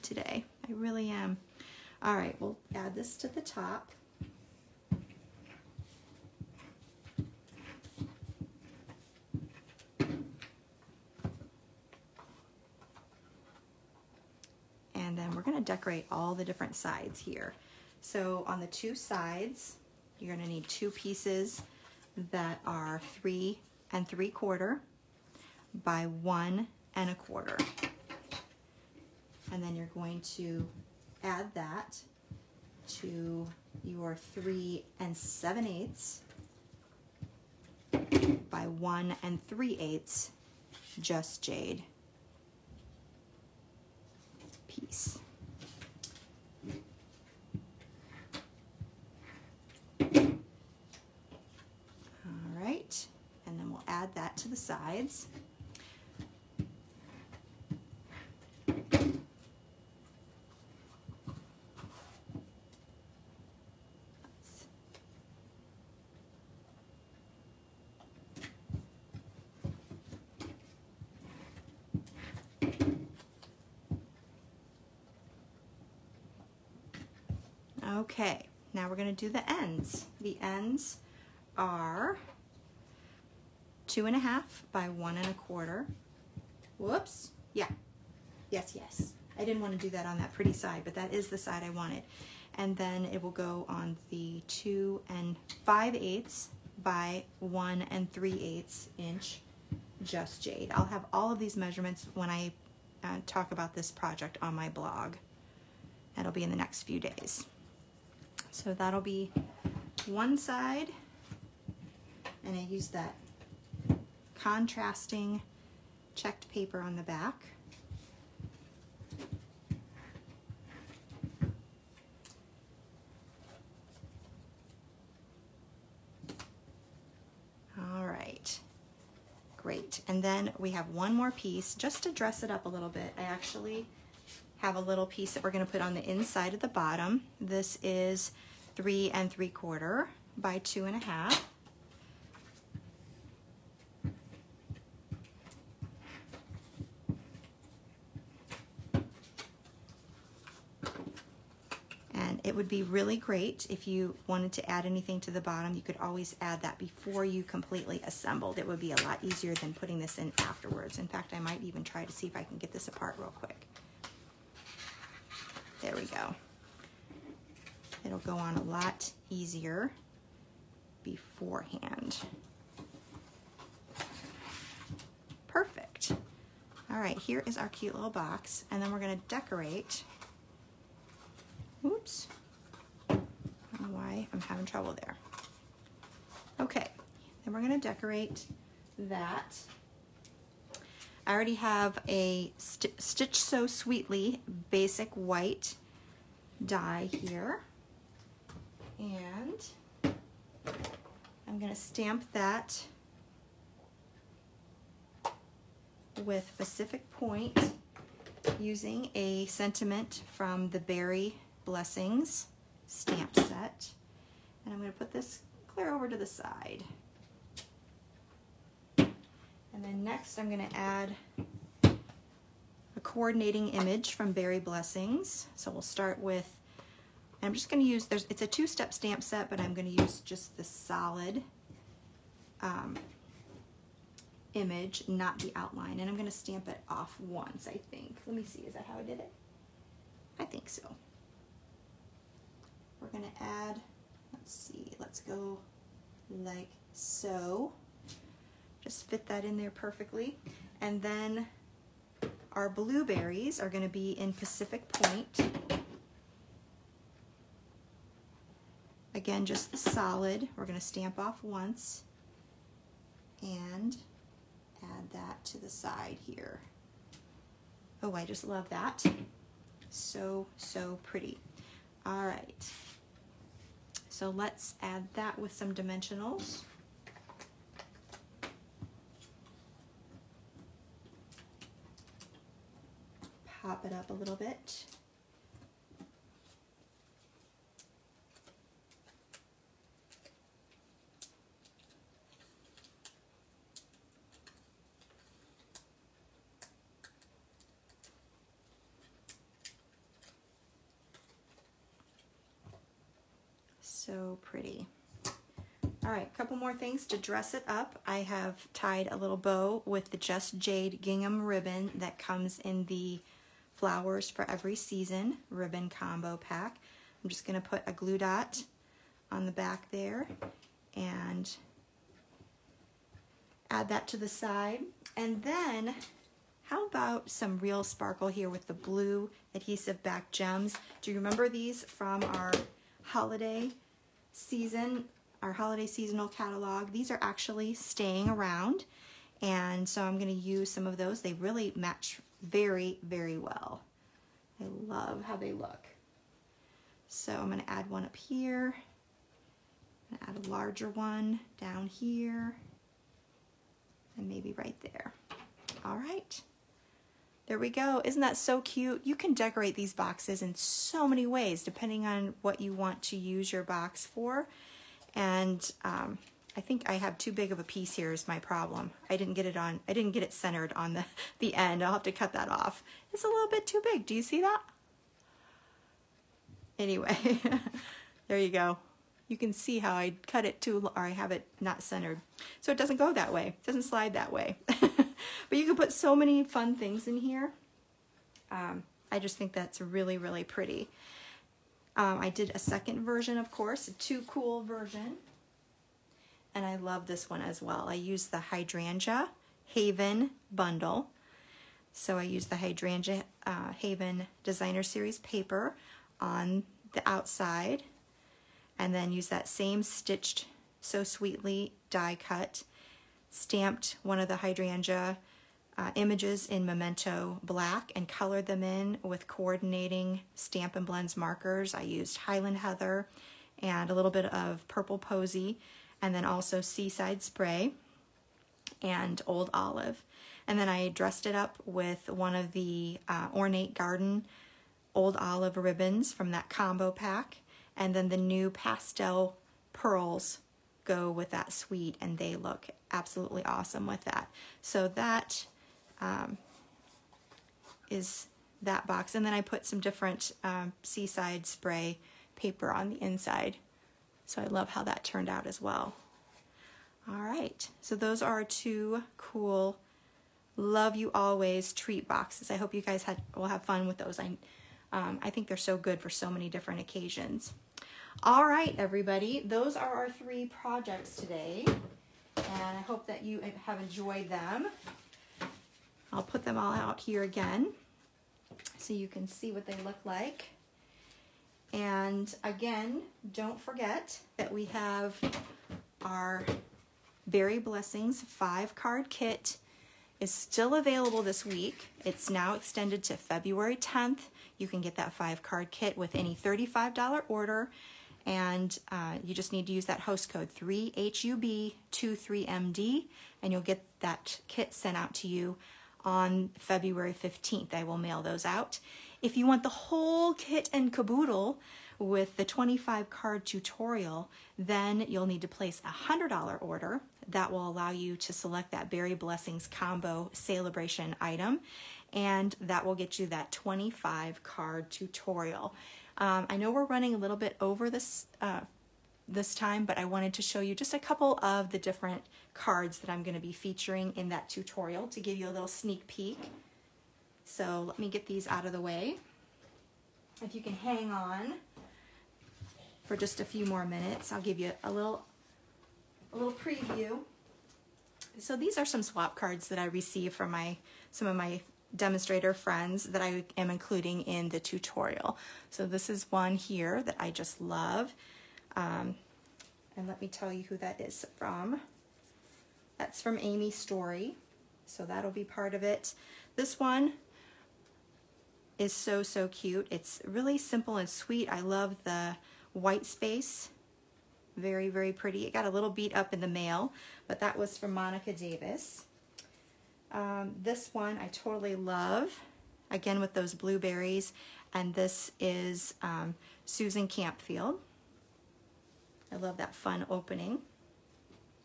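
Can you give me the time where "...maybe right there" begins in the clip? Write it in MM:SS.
05:54.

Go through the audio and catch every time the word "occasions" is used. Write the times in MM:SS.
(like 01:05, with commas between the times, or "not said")
07:46.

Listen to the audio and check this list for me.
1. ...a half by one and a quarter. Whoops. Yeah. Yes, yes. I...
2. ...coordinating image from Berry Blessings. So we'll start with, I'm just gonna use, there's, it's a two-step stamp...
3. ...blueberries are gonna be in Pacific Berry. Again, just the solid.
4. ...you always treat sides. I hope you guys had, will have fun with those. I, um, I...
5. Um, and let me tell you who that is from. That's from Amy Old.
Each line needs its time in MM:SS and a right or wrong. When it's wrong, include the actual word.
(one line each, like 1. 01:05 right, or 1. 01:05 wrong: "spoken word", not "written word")
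1. 01:24 right
2. 03:43 right
3. 04:12 wrong: "Point", not "Berry"
4. 07:40 wrong: "boxes", not "sides"
5. 09:18 wrong: "Story", not "Old".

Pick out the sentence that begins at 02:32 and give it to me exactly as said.
And it would be really great if you wanted to add anything to the bottom.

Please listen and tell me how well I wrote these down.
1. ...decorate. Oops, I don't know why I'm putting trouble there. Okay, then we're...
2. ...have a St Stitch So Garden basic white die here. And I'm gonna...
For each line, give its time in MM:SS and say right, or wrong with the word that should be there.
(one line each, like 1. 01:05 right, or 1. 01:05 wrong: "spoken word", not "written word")
1. 02:59 wrong: "having", not "putting"
2. 03:11 wrong: "Sweetly", not "Garden".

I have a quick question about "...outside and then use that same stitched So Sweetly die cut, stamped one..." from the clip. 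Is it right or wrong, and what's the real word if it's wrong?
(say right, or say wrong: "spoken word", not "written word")
right.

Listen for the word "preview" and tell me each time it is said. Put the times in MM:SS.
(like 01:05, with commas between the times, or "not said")
09:06.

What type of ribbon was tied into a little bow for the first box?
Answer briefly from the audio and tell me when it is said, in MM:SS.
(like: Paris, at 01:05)
Just Jade gingham ribbon, at 05:10.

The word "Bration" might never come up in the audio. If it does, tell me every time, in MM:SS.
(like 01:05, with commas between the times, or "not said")
08:40.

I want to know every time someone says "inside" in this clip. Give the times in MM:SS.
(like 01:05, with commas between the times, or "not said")
02:16, 07:33.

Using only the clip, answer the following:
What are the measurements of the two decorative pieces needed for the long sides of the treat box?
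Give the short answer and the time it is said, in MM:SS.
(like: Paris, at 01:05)
3 3/4 by 1 1/4, at 00:23.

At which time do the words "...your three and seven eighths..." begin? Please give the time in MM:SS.
00:33.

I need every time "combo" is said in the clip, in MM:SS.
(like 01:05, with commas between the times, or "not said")
05:15, 07:16, 08:39.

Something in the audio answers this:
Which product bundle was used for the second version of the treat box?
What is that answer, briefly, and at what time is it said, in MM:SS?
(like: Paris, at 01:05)
Hydrangea Haven, at 06:38.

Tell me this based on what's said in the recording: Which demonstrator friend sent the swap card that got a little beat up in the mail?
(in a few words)
Monica Davis.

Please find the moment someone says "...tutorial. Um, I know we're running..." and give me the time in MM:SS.
08:44.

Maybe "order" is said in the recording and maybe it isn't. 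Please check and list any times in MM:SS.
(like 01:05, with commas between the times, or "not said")
08:17, 08:36.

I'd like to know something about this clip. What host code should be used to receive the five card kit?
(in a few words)
3HUB23MD.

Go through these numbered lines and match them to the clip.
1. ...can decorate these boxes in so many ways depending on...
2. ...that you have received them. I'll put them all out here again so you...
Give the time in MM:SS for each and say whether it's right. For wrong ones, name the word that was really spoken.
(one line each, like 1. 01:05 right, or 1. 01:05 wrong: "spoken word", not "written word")
1. 05:59 right
2. 07:53 wrong: "enjoyed", not "received".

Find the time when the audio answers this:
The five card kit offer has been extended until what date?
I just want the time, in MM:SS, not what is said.
08:13.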